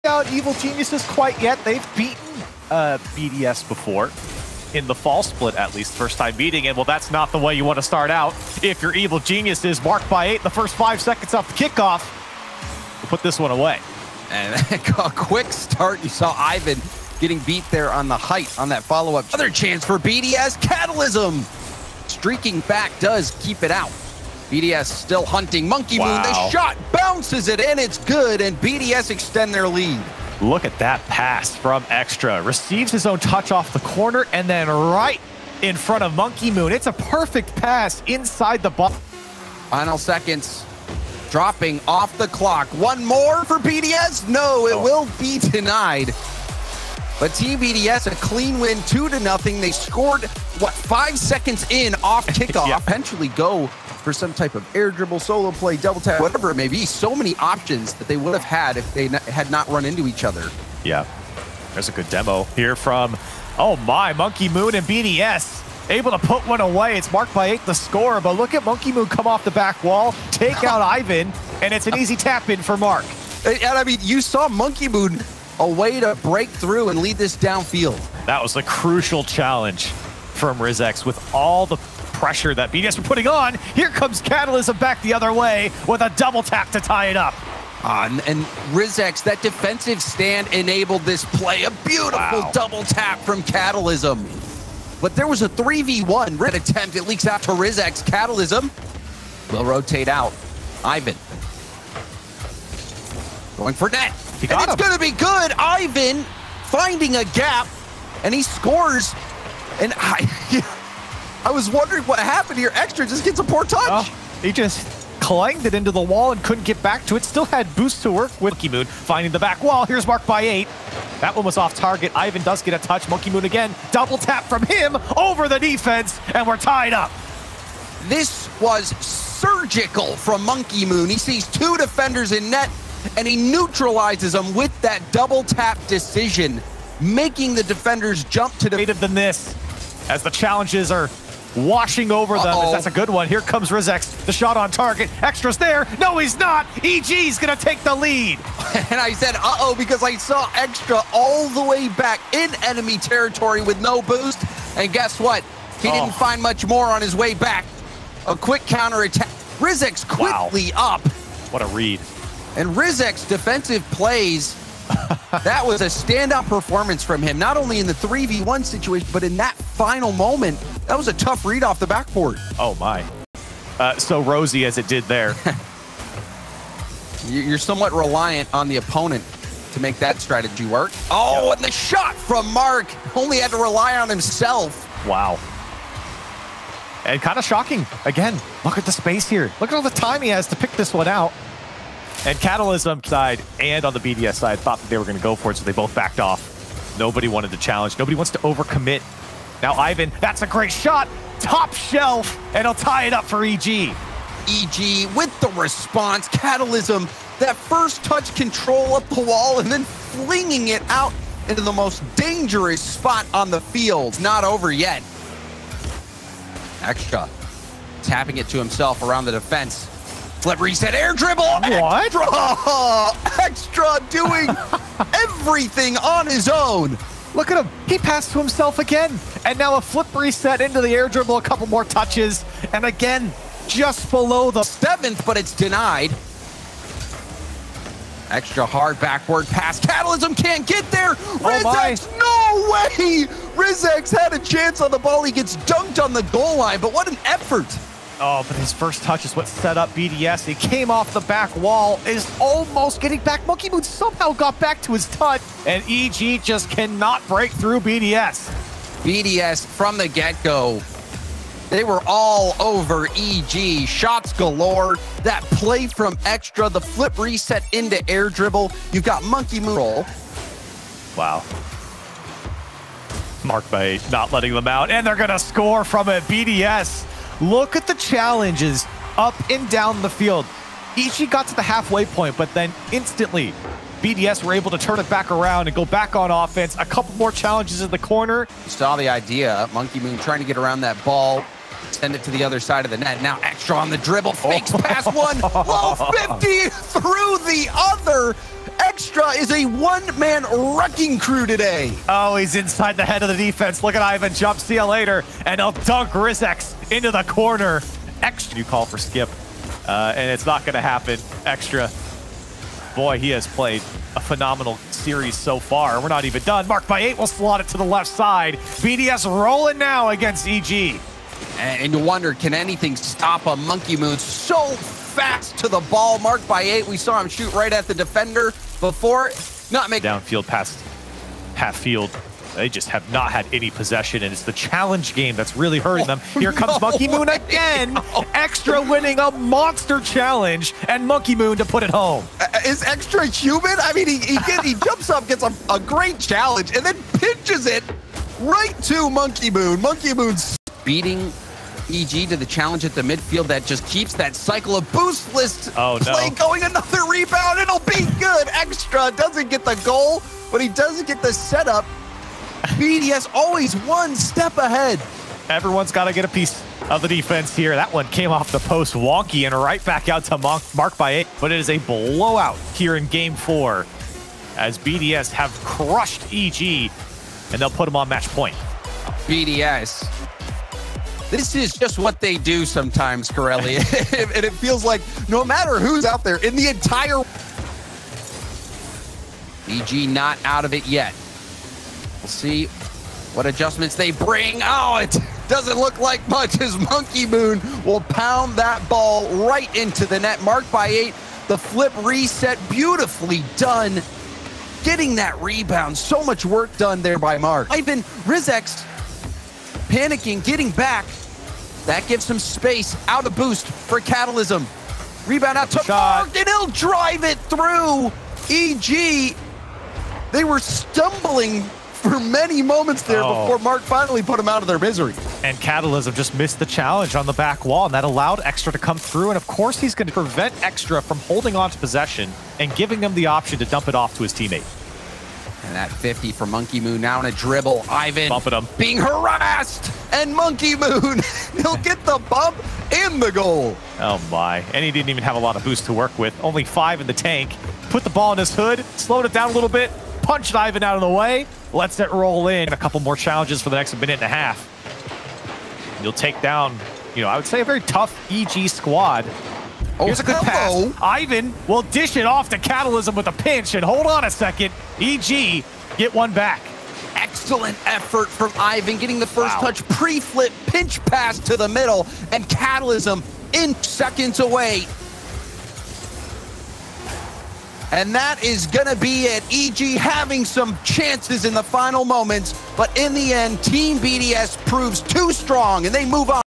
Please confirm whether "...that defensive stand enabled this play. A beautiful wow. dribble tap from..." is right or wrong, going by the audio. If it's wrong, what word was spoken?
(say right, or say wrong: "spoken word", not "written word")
wrong: "double", not "dribble".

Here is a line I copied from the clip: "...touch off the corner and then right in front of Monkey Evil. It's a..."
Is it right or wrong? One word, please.
wrong.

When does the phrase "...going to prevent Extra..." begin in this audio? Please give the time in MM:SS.
07:09.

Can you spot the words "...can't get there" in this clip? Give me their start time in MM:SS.
04:00.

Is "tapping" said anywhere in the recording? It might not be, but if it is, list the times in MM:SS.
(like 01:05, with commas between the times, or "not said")
03:38.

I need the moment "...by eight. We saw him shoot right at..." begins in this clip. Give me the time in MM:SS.
05:26.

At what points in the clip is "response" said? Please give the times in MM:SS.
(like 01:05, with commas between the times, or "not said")
03:25.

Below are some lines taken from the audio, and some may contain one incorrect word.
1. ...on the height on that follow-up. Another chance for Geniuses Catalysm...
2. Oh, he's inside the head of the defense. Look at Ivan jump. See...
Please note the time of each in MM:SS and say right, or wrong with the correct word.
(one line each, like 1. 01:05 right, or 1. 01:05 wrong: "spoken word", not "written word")
1. 00:17 wrong: "BDS", not "Geniuses"
2. 05:02 right.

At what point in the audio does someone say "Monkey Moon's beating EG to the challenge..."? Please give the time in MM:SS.
05:49.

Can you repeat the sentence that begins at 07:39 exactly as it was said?
Oh, Here's a oh, good hello.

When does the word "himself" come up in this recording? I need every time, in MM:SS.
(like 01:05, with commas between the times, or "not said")
03:04, 03:38, 03:48.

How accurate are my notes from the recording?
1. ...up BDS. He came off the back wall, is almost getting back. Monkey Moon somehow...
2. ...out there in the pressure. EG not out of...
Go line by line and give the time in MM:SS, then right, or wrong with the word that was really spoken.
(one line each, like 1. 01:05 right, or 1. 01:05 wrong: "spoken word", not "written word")
1. 04:09 right
2. 06:26 wrong: "entire", not "pressure".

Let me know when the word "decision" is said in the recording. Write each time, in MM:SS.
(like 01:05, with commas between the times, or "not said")
02:15.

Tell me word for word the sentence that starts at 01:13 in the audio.
And, and I mean, you saw Monkey Moon a way to break through and lead this downfield.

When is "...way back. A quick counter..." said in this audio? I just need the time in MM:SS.
02:37.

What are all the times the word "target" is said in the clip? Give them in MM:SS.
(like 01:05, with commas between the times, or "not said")
02:01, 02:24.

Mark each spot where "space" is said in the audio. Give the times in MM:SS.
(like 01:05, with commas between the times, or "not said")
03:08, 06:52.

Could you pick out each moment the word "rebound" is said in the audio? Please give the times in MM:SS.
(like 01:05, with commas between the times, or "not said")
05:57, 06:45, 06:55.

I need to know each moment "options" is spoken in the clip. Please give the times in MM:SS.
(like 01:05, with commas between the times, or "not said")
00:57, 07:13.